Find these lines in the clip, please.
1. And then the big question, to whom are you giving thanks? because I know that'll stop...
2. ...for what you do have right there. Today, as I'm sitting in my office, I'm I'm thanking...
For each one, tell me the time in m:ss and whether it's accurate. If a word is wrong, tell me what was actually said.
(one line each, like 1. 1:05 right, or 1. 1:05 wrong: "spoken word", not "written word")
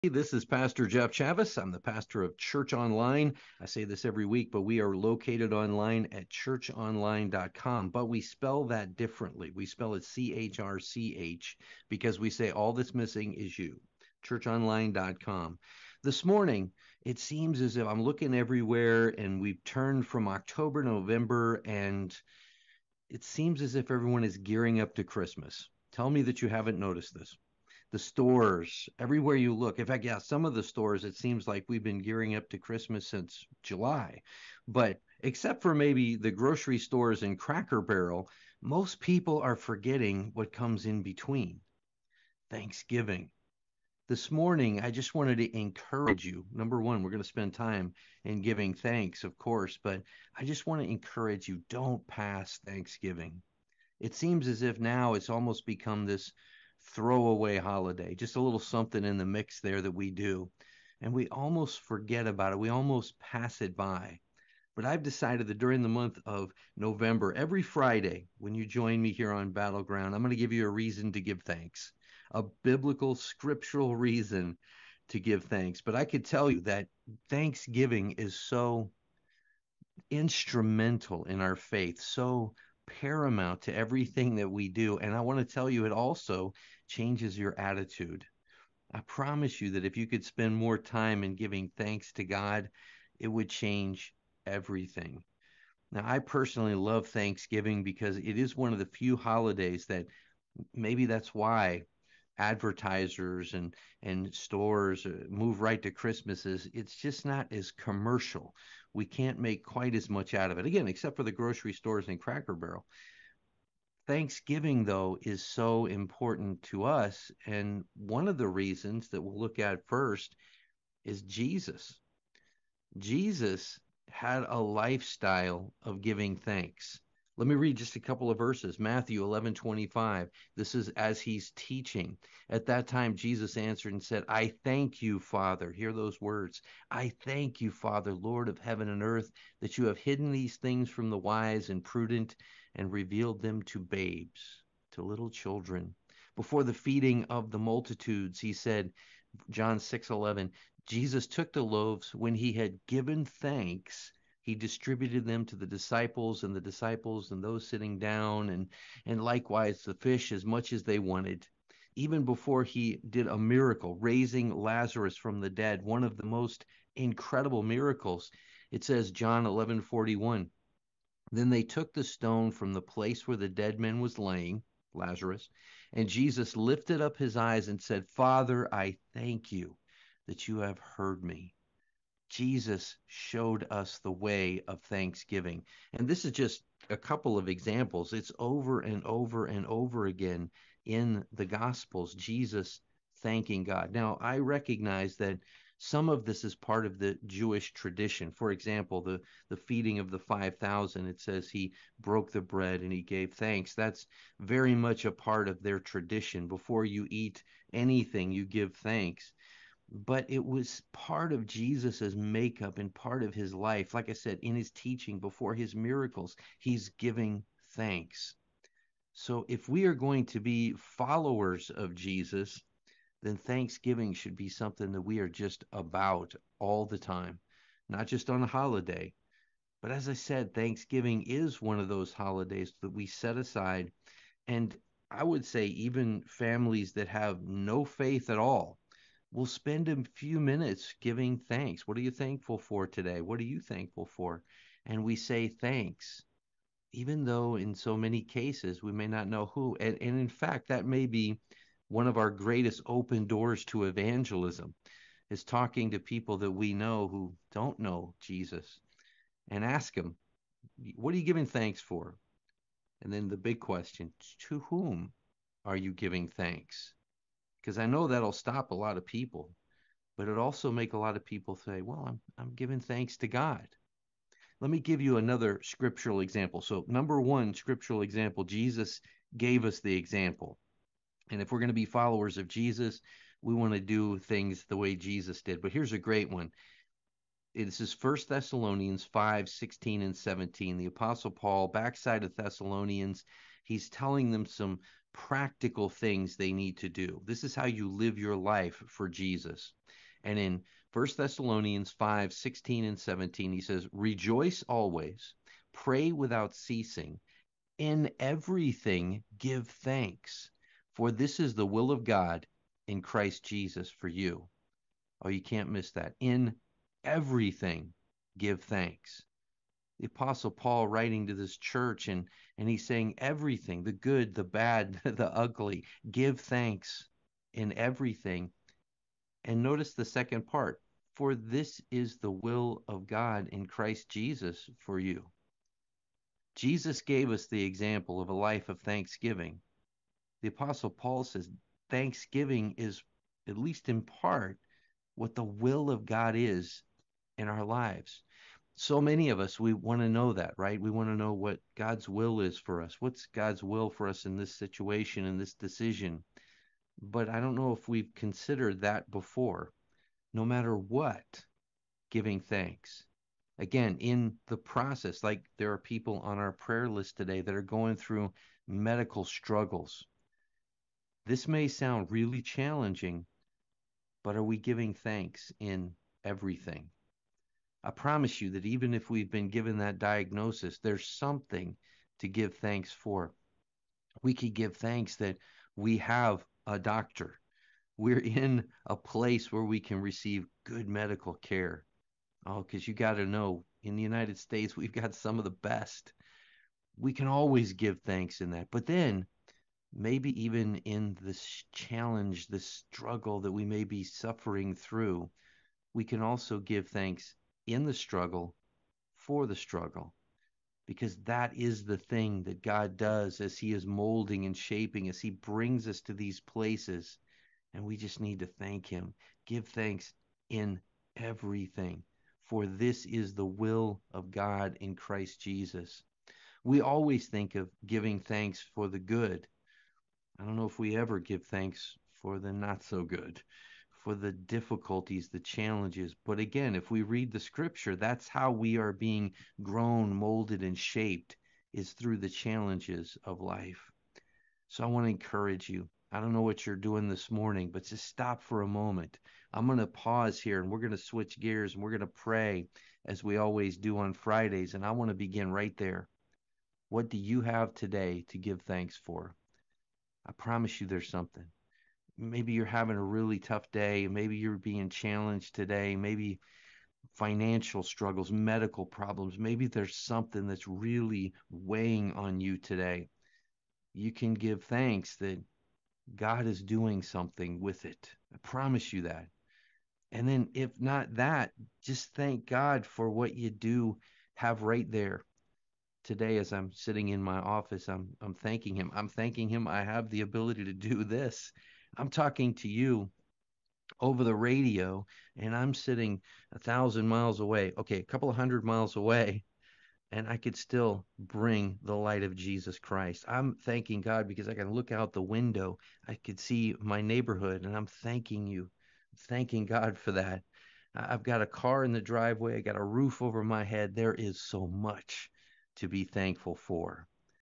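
1. 4:23 right
2. 8:02 right.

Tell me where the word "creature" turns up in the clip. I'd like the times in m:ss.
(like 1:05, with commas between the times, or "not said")
not said.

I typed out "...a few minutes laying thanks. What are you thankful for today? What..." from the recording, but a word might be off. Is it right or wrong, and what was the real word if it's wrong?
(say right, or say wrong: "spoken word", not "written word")
wrong: "giving", not "laying".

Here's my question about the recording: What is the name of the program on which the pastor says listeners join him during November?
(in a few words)
Battleground.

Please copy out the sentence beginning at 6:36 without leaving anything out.
We can always give thanks in that.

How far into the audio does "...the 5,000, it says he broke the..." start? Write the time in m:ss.
3:20.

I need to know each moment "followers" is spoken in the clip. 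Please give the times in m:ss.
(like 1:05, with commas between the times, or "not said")
3:40, 4:41.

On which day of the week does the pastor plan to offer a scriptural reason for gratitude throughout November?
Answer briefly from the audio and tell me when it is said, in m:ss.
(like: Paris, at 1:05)
Friday, at 1:07.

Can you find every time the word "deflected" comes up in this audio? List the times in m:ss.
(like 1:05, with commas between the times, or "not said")
not said.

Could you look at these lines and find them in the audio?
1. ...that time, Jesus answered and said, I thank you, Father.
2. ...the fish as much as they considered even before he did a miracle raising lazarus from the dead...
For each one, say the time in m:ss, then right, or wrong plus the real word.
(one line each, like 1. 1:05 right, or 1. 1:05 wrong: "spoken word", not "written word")
1. 2:12 right
2. 2:39 wrong: "wanted", not "considered".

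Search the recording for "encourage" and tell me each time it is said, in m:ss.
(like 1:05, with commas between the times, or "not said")
0:45, 0:50, 7:25.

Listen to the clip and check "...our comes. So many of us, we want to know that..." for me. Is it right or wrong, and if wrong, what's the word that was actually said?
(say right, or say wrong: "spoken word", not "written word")
wrong: "lives", not "comes".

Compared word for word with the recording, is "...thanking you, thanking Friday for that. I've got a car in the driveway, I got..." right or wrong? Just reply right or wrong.
wrong.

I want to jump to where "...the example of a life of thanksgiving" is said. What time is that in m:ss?
5:37.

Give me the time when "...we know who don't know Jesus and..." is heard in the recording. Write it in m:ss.
4:16.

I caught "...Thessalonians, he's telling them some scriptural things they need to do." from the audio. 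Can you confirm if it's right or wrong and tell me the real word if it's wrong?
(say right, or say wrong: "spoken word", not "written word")
wrong: "practical", not "scriptural".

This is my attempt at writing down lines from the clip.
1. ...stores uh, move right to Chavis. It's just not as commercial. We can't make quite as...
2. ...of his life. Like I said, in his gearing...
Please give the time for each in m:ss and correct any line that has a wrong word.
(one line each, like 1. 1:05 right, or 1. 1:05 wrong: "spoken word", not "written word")
1. 1:44 wrong: "Christmases", not "Chavis"
2. 3:33 wrong: "teaching", not "gearing".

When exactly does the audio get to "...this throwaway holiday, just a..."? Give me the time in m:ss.
0:56.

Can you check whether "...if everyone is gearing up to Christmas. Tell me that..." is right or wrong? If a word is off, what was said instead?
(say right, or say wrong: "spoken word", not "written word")
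right.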